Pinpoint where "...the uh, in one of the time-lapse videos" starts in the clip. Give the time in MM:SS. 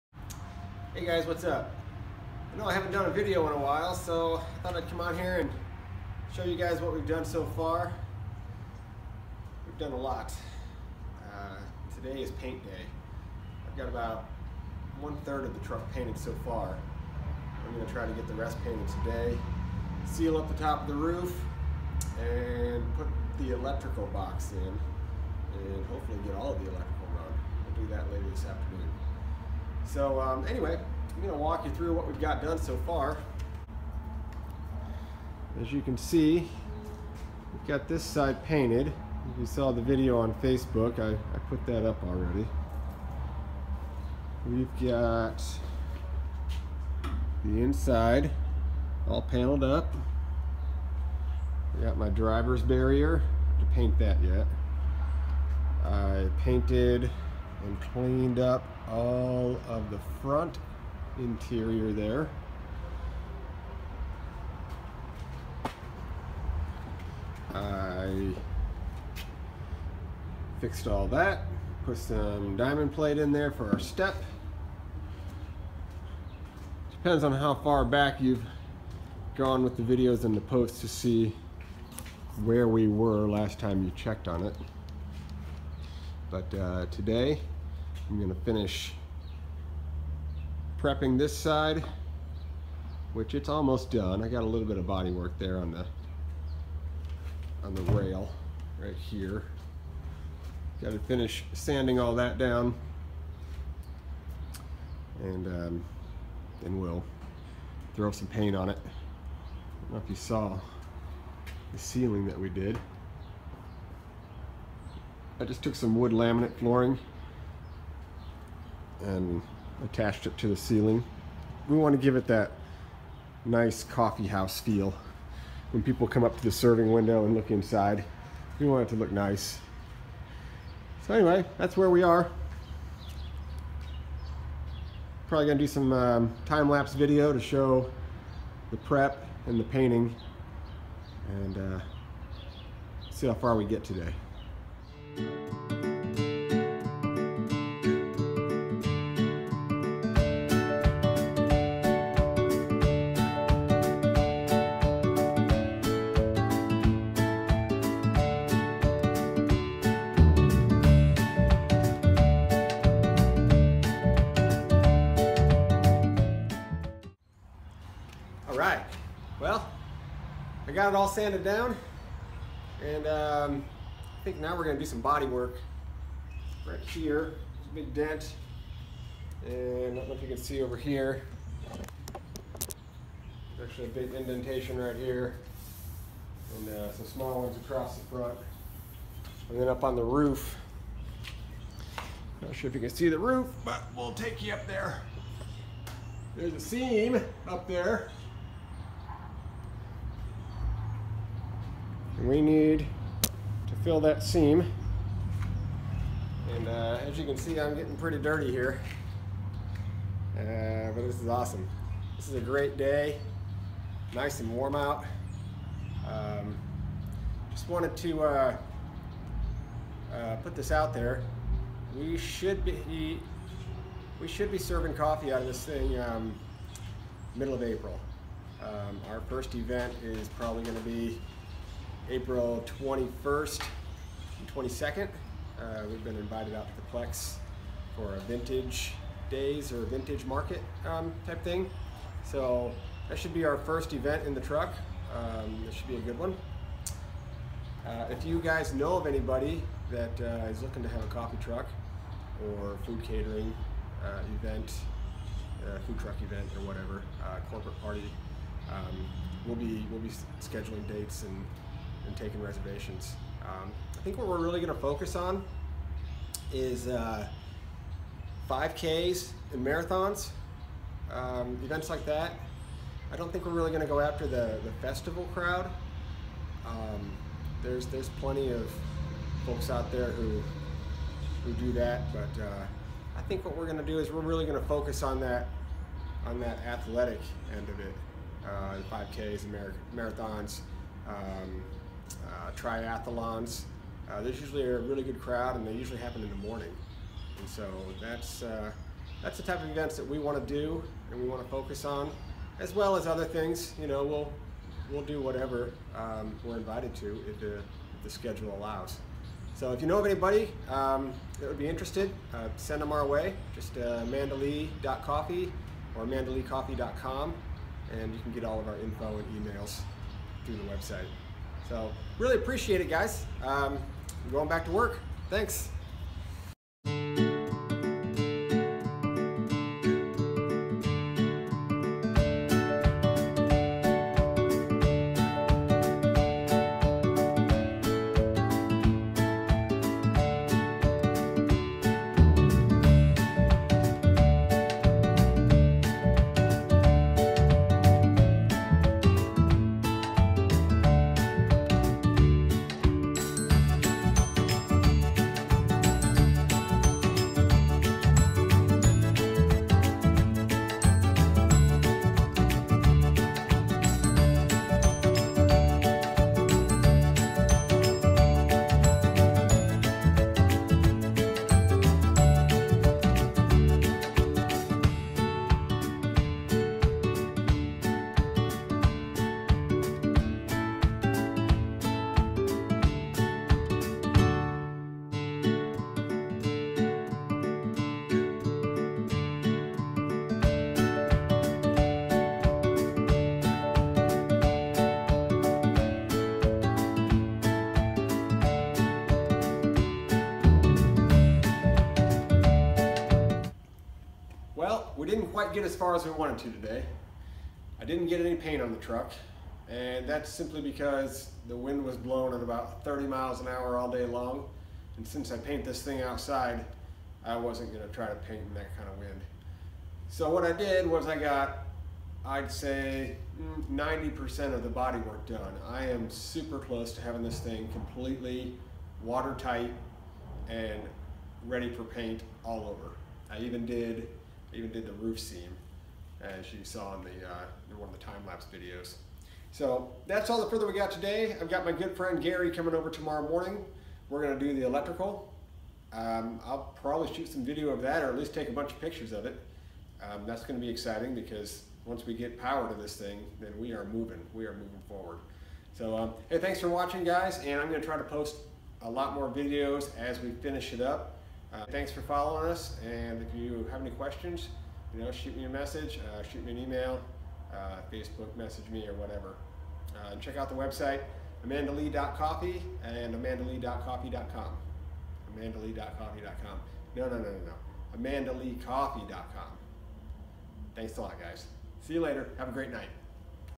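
07:17.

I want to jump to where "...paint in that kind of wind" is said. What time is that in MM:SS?
06:58.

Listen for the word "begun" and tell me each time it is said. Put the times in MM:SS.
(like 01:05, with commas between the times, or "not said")
not said.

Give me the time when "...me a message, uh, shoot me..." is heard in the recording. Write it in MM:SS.
07:45.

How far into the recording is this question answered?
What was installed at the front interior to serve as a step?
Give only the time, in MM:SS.
01:12.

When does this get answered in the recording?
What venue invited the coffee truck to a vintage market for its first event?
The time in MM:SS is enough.
03:56.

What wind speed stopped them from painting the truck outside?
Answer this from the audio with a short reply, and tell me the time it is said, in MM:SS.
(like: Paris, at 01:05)
30 miles an hour, at 06:52.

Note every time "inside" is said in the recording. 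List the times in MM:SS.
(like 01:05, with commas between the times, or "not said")
00:47, 02:07.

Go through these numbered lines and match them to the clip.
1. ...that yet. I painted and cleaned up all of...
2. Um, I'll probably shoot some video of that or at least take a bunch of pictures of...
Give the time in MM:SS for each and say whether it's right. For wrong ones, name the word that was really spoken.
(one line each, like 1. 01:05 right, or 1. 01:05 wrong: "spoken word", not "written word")
1. 00:53 right
2. 07:25 right.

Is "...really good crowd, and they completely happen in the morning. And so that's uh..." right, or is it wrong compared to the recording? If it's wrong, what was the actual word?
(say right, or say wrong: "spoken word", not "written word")
wrong: "usually", not "completely".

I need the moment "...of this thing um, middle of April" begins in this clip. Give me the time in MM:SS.
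03:45.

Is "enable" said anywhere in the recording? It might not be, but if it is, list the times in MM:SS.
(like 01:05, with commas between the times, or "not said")
not said.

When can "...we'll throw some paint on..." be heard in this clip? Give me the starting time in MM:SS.
01:46.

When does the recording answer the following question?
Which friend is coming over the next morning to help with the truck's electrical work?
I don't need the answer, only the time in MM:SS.
07:22.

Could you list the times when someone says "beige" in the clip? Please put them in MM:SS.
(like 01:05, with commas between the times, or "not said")
not said.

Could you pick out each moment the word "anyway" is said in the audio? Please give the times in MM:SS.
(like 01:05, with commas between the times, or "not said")
00:30, 02:11.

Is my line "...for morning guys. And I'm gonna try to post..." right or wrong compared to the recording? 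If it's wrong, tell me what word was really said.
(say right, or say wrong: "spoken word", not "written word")
wrong: "watching", not "morning".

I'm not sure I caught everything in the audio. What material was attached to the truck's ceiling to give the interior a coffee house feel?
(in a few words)
wood laminate flooring.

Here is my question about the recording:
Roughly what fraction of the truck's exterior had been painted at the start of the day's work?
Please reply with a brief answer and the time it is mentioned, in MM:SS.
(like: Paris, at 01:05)
one third, at 00:14.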